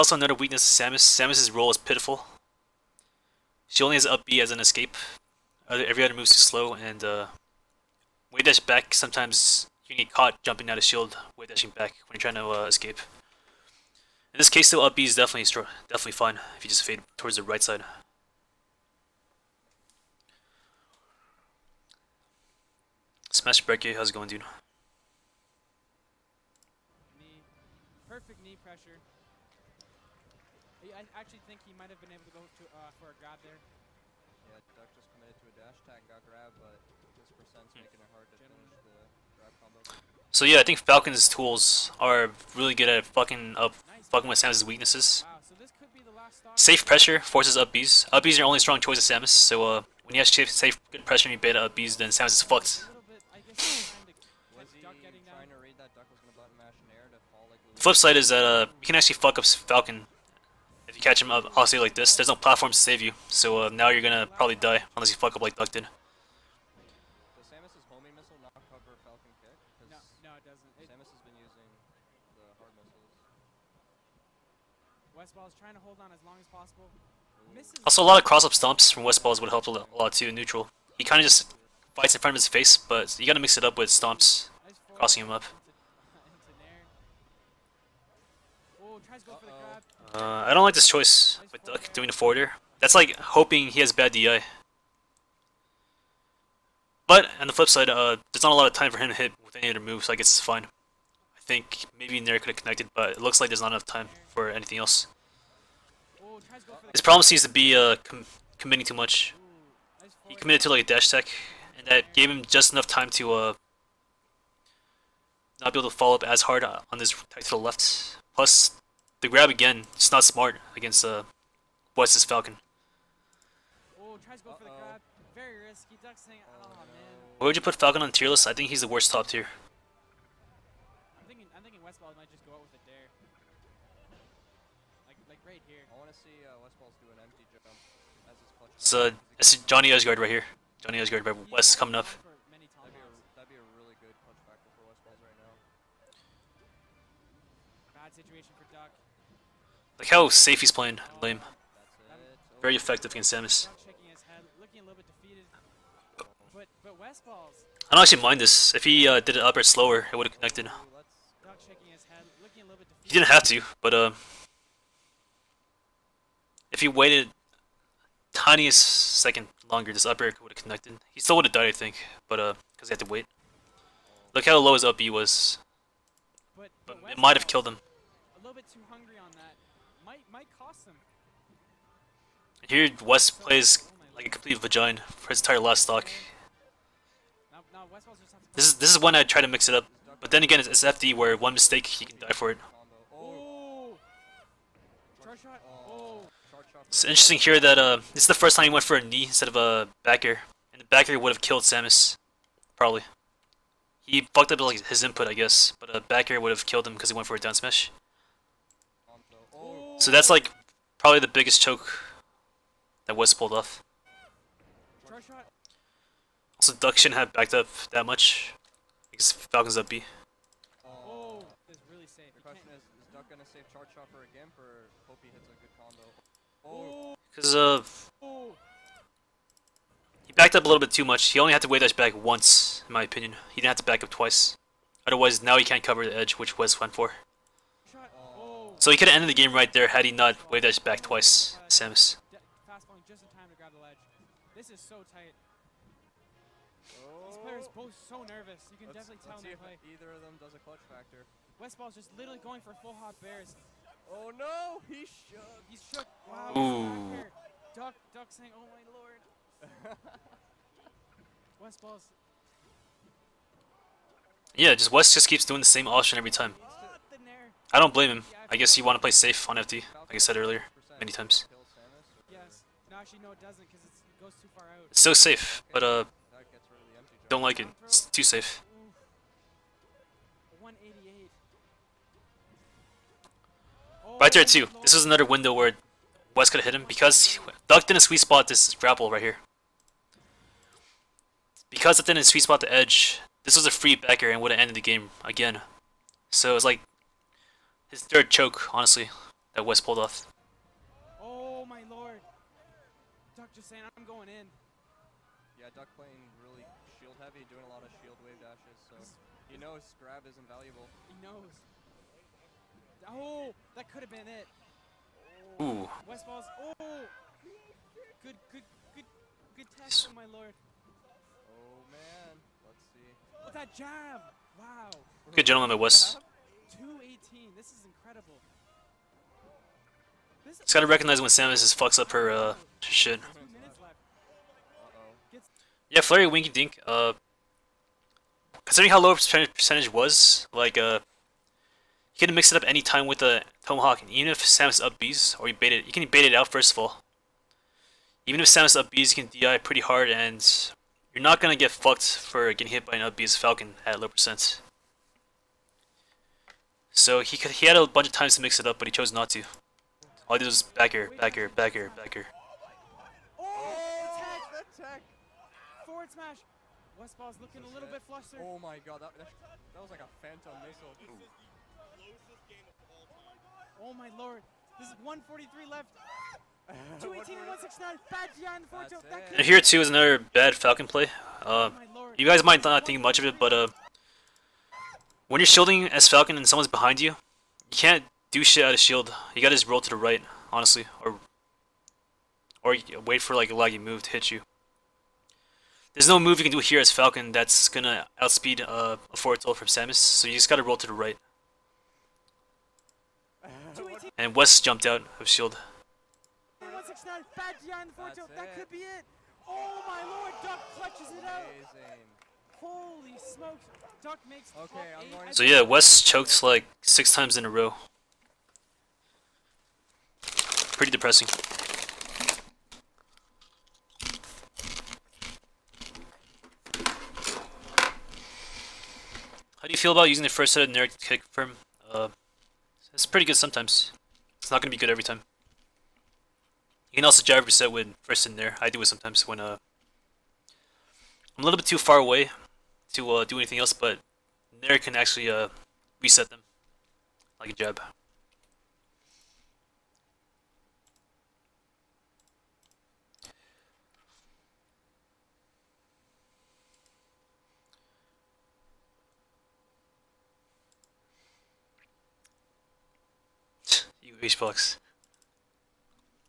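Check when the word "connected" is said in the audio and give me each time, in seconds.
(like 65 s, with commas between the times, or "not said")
102 s, 160 s, 170 s.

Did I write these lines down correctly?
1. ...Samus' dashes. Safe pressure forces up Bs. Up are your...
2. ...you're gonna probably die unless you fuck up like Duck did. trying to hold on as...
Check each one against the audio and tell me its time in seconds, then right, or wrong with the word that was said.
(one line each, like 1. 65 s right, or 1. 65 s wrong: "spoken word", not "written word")
1. 44 s wrong: "weaknesses", not "dashes"
2. 63 s right.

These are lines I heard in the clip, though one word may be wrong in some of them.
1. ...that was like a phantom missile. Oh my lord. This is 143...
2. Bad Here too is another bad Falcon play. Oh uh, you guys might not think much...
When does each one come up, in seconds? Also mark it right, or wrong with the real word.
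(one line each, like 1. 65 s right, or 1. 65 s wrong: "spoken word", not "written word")
1. 369 s right
2. 378 s right.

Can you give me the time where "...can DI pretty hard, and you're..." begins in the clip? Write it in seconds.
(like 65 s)
349 s.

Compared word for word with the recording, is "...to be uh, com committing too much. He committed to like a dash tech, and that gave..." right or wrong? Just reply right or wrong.
right.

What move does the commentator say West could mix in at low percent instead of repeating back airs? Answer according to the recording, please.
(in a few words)
Tomahawk.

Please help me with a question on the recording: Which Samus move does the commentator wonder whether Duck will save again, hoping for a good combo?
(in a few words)
Charge Chopper.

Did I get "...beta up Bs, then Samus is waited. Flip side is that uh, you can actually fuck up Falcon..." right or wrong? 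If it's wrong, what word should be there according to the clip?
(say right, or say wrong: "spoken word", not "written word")
wrong: "fucked", not "waited".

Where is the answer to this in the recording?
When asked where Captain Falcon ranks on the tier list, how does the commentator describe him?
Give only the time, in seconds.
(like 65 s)
128 s.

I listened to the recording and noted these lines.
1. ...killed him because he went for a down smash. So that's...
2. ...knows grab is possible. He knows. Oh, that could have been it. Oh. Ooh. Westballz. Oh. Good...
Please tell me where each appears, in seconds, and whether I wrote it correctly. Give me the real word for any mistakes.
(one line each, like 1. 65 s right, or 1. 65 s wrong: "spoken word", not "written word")
1. 206 s right
2. 309 s wrong: "invaluable", not "possible".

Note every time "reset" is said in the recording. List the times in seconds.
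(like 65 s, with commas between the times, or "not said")
437 s, 446 s.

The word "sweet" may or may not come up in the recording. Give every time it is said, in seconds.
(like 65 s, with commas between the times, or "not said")
287 s, 292 s.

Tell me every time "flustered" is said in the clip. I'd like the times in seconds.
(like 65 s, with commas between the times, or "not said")
368 s.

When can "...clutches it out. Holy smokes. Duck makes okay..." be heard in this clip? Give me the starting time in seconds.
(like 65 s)
410 s.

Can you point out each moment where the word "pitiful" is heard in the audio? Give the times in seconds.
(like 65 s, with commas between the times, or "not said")
1 s.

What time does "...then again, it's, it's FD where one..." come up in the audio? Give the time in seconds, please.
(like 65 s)
190 s.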